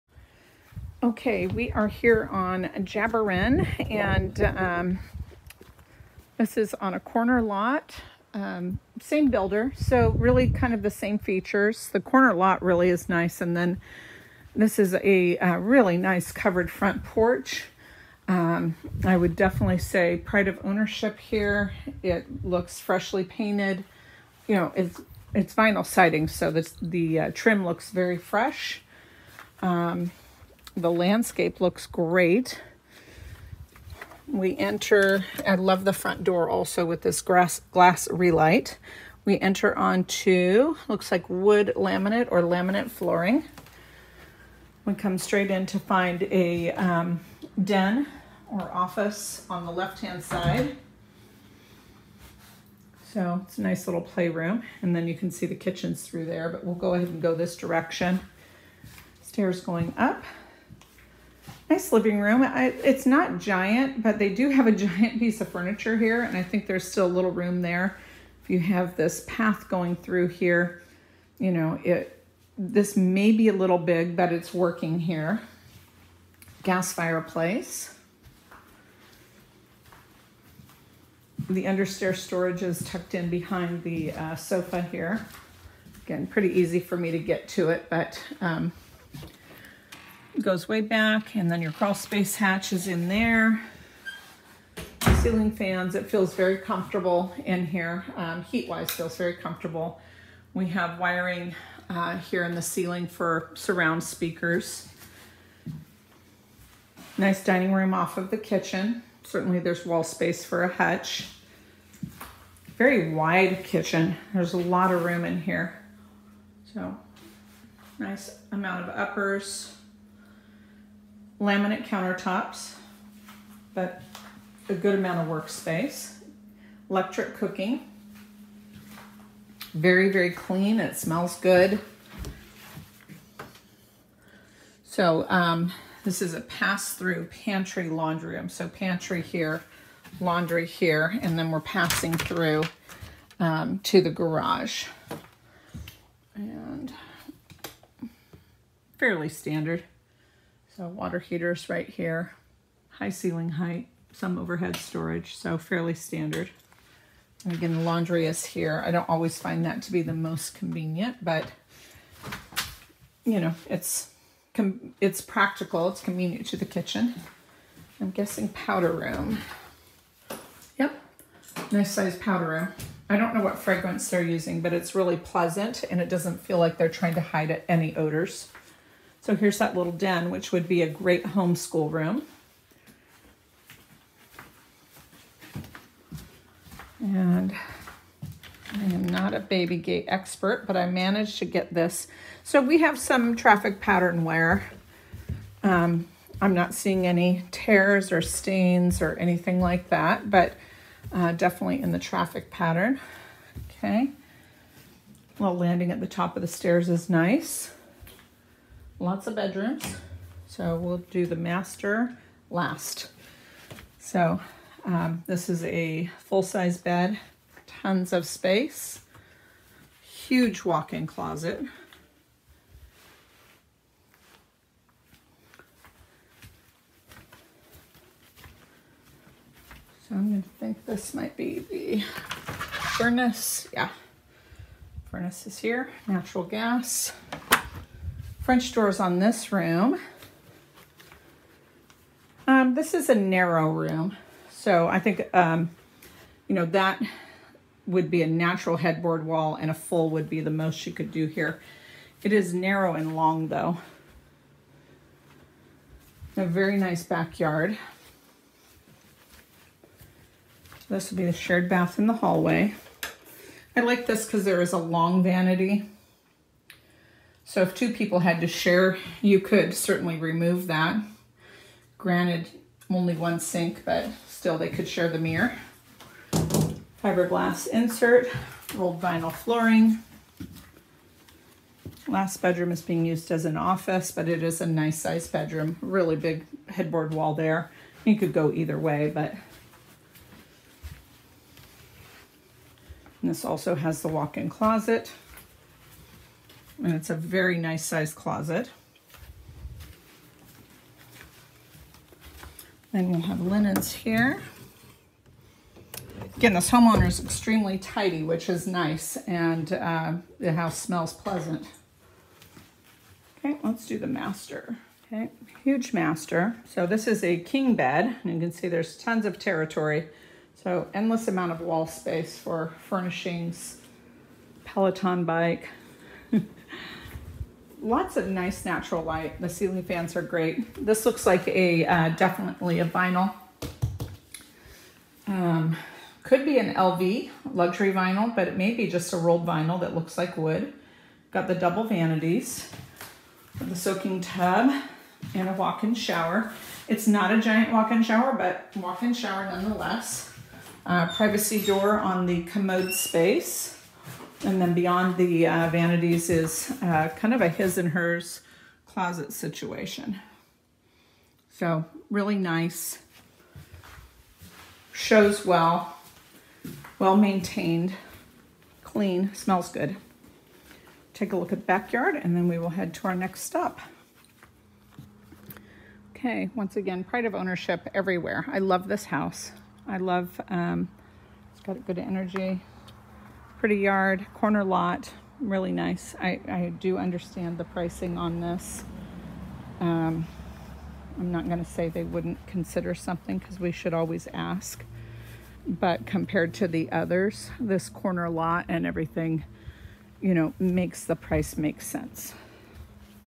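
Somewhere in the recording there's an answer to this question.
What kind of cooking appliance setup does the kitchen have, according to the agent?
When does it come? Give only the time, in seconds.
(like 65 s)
126 s.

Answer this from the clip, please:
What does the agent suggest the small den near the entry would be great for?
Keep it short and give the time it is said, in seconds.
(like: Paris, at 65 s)
homeschool room, at 181 s.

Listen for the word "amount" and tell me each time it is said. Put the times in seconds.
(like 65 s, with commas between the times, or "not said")
118 s, 124 s, 321 s.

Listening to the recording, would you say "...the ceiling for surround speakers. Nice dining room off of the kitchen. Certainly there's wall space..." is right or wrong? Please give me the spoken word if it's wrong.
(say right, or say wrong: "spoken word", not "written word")
right.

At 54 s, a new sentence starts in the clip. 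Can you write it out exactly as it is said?
And then you can see the kitchens through there, but we'll go ahead and go this direction.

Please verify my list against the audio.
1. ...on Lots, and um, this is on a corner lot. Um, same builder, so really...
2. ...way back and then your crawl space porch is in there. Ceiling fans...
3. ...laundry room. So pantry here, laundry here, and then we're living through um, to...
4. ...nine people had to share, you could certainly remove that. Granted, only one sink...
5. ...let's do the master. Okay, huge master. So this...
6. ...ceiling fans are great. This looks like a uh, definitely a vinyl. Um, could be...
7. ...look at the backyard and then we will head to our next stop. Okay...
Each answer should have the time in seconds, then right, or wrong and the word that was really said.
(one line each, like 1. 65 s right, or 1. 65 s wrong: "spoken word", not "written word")
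1. 2 s wrong: "Jarbirin", not "Lots"
2. 90 s wrong: "hatch", not "porch"
3. 137 s wrong: "passing", not "living"
4. 267 s wrong: "two", not "nine"
5. 313 s right
6. 329 s right
7. 371 s right.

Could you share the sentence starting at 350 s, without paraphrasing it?
Uh, privacy door on the commode space.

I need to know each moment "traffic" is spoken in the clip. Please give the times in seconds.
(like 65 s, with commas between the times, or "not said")
193 s, 201 s.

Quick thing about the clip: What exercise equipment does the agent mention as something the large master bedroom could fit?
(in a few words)
Peloton bike.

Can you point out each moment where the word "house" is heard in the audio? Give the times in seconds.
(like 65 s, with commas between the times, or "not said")
310 s, 379 s.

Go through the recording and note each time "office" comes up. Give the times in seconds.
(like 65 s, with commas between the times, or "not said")
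48 s, 283 s.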